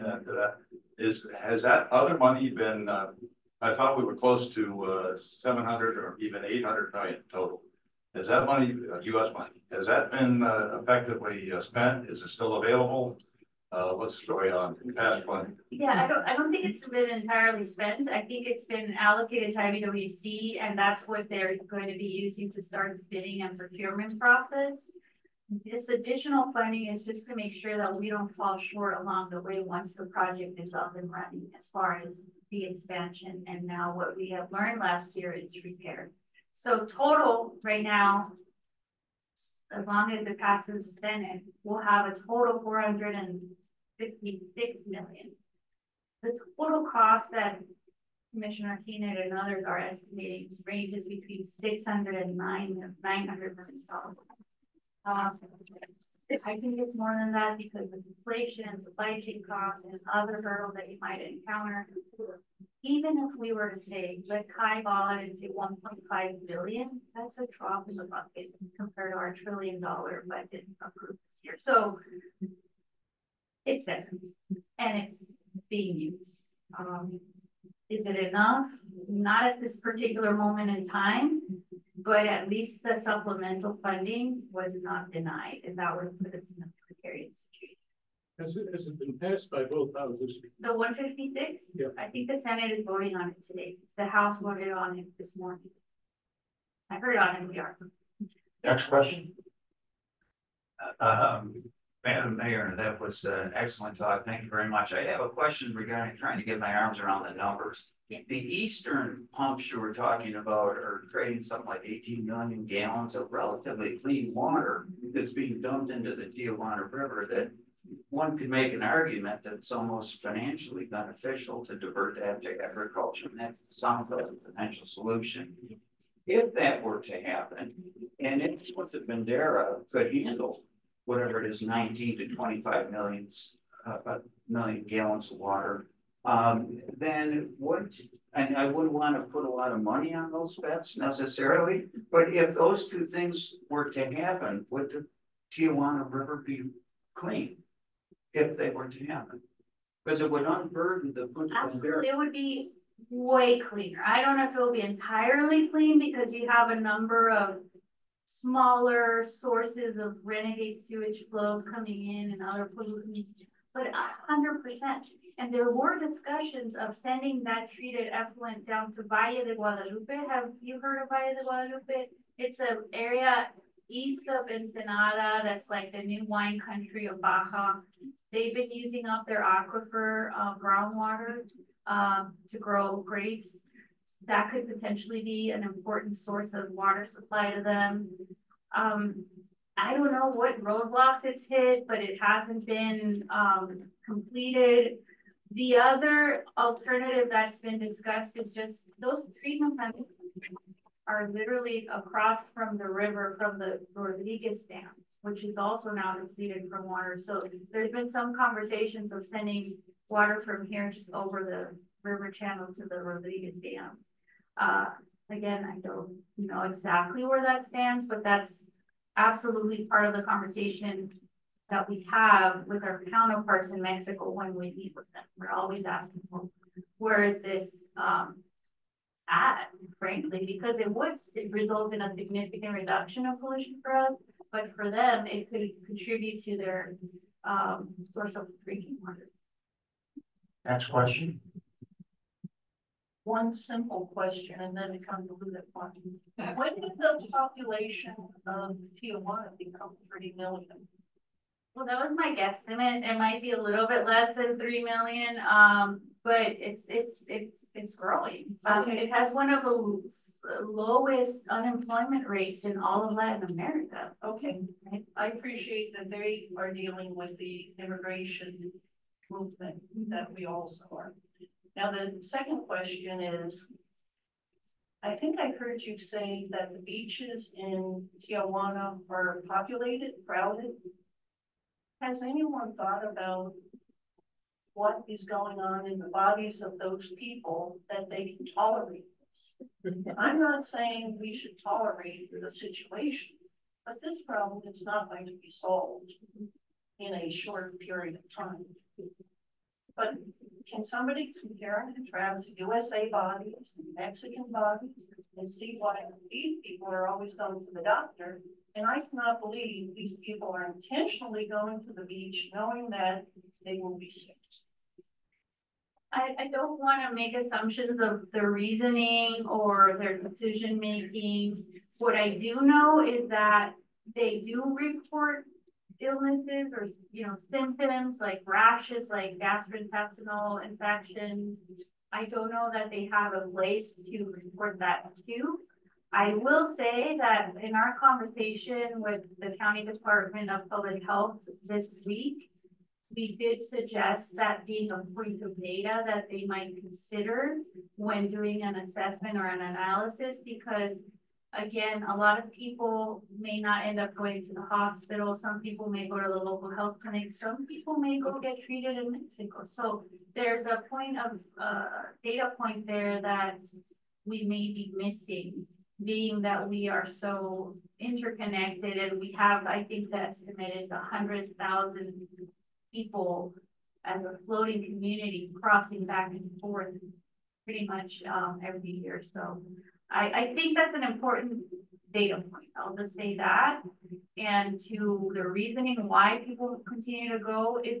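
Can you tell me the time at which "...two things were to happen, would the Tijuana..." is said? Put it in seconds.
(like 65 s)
142 s.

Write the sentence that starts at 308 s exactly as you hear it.
And I cannot believe these people are intentionally going to the beach knowing that they will be sick.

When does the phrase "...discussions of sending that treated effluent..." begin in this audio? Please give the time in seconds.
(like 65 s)
165 s.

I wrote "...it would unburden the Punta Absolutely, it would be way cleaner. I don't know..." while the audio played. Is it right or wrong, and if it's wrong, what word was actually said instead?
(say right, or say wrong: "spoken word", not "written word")
right.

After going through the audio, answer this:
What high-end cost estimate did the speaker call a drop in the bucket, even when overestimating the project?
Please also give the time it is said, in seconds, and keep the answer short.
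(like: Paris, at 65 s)
1.5 billion, at 65 s.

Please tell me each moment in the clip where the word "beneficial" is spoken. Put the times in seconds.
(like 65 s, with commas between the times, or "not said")
120 s.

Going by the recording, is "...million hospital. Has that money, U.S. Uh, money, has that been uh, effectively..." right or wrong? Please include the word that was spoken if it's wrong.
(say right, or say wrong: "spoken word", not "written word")
wrong: "total", not "hospital".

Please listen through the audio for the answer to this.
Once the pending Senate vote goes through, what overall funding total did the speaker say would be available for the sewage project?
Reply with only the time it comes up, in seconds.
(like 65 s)
42 s.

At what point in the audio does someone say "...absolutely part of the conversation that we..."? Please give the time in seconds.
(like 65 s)
219 s.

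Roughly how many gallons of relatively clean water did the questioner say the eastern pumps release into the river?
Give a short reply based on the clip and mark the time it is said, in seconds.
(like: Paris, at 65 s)
18 million gallons, at 111 s.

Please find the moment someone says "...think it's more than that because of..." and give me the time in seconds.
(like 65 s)
56 s.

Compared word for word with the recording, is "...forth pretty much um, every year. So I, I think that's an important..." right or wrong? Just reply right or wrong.
right.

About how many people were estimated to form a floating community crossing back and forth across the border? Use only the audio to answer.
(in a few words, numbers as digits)
100,000.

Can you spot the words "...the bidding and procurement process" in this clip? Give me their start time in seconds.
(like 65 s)
22 s.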